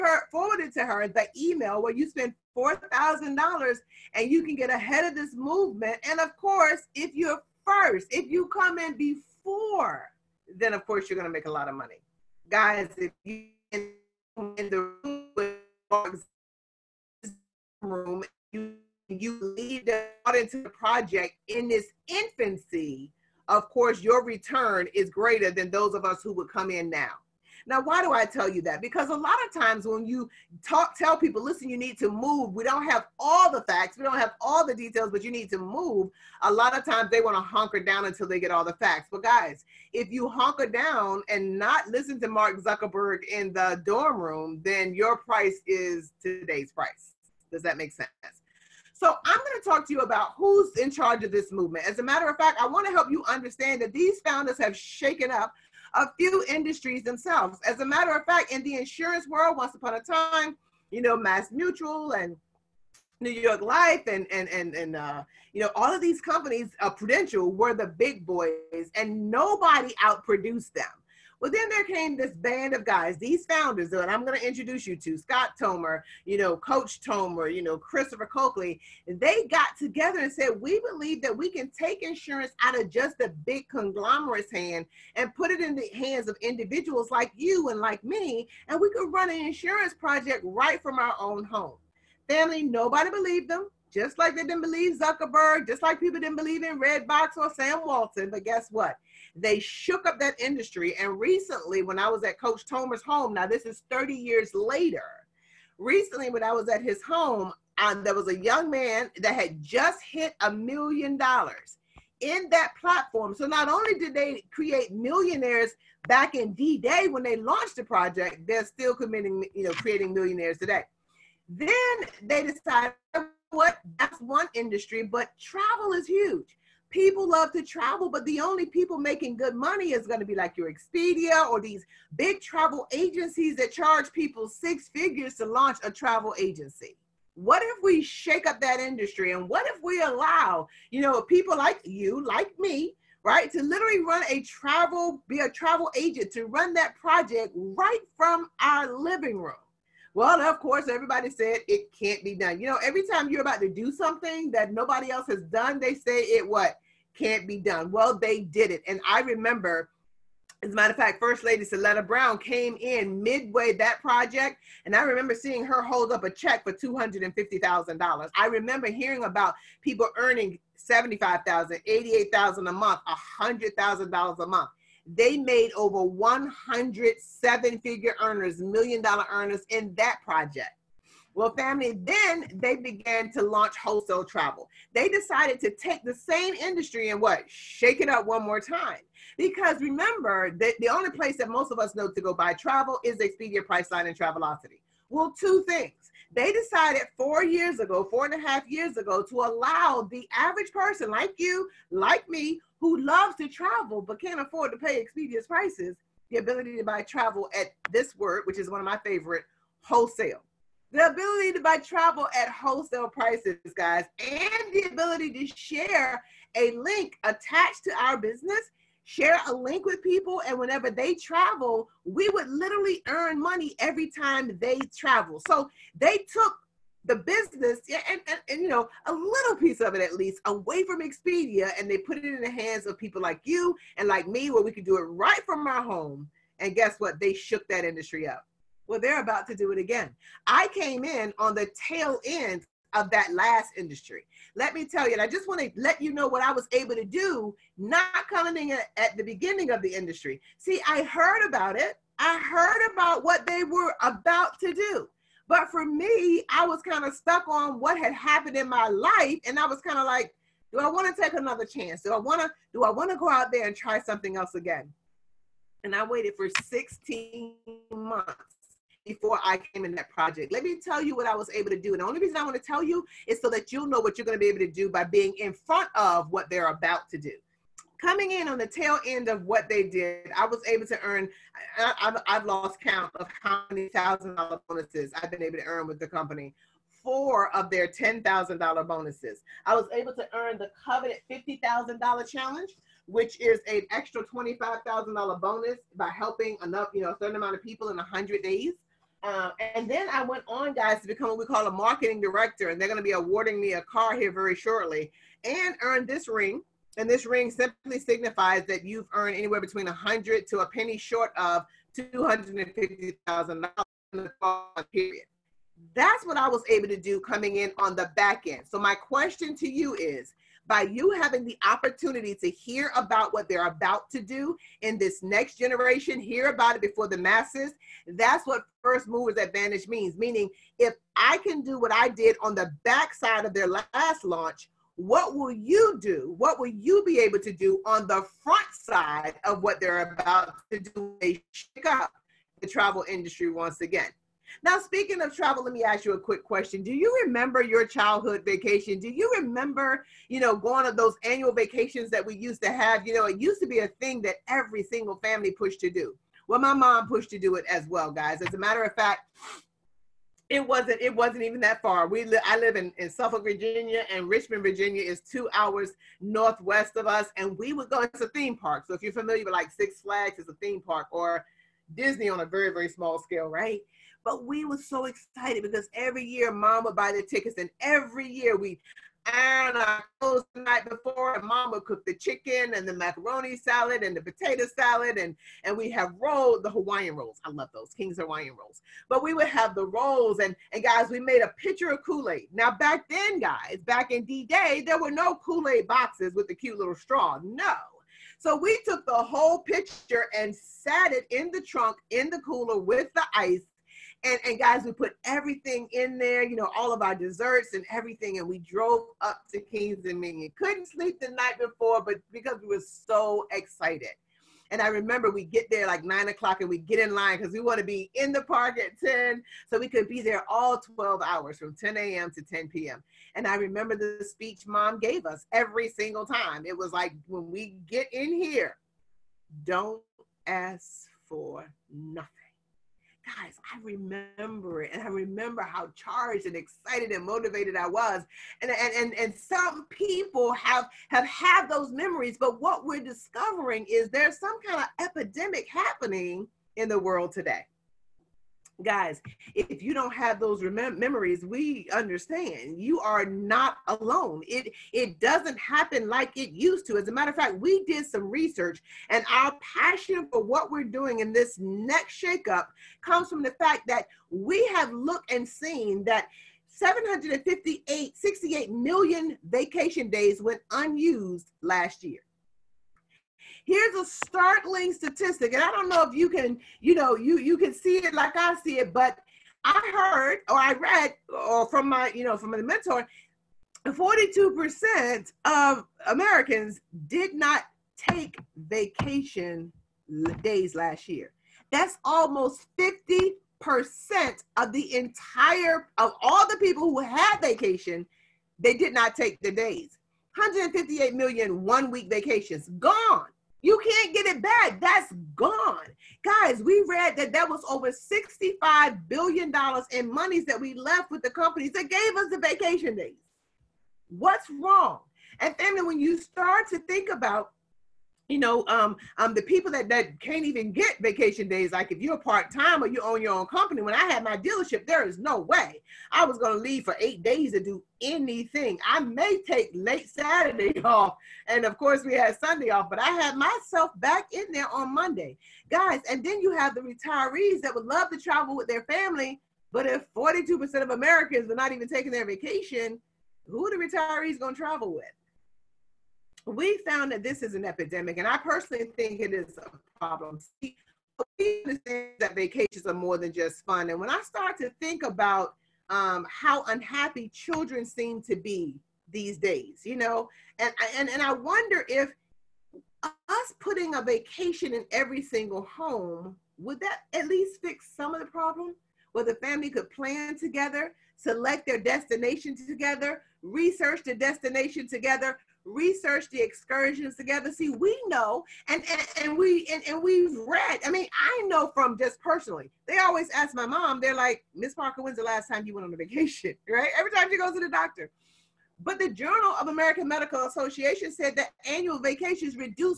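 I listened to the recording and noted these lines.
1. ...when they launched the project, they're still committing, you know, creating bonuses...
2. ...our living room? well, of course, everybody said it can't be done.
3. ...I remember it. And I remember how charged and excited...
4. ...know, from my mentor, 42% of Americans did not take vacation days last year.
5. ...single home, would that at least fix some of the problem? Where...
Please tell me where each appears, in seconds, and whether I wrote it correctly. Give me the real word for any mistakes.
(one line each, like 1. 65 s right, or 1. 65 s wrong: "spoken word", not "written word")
1. 117 s wrong: "millionaires", not "bonuses"
2. 148 s right
3. 433 s right
4. 482 s right
5. 565 s right.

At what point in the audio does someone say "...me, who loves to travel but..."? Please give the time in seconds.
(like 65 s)
202 s.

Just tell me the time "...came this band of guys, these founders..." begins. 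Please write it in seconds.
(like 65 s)
71 s.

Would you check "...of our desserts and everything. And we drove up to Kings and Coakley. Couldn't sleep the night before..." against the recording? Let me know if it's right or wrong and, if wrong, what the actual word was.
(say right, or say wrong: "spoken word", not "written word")
wrong: "Dominion", not "Coakley".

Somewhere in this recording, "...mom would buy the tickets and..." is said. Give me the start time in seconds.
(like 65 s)
376 s.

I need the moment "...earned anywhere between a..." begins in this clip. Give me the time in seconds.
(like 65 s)
309 s.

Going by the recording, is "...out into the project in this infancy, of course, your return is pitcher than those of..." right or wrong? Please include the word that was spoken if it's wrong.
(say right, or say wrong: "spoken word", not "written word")
wrong: "greater", not "pitcher".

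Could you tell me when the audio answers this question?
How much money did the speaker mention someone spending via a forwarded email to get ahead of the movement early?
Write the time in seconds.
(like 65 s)
2 s.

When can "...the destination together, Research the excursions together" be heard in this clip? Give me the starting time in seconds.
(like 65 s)
574 s.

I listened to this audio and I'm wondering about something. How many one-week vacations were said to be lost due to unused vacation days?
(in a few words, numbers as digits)
158 million.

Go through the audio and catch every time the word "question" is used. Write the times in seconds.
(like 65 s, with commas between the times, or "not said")
318 s, 346 s.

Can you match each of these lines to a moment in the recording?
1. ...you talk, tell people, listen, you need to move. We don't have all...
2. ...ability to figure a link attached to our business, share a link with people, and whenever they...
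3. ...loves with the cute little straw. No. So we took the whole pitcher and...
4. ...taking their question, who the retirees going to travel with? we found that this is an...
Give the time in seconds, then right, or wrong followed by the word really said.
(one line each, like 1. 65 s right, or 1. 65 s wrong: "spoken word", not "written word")
1. 30 s right
2. 214 s wrong: "share", not "figure"
3. 395 s wrong: "boxes", not "loves"
4. 541 s wrong: "vacation", not "question".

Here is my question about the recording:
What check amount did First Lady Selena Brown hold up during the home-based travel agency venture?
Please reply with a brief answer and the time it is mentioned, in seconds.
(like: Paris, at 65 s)
$250,000, at 166 s.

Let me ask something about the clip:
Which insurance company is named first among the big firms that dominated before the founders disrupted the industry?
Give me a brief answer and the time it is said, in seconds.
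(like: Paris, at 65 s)
Mass Mutual, at 61 s.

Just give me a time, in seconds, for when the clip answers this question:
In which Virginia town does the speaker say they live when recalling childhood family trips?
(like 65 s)
363 s.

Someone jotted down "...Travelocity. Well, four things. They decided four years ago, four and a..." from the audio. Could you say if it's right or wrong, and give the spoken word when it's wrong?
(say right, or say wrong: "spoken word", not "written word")
wrong: "two", not "four".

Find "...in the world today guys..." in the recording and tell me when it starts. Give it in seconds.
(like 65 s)
446 s.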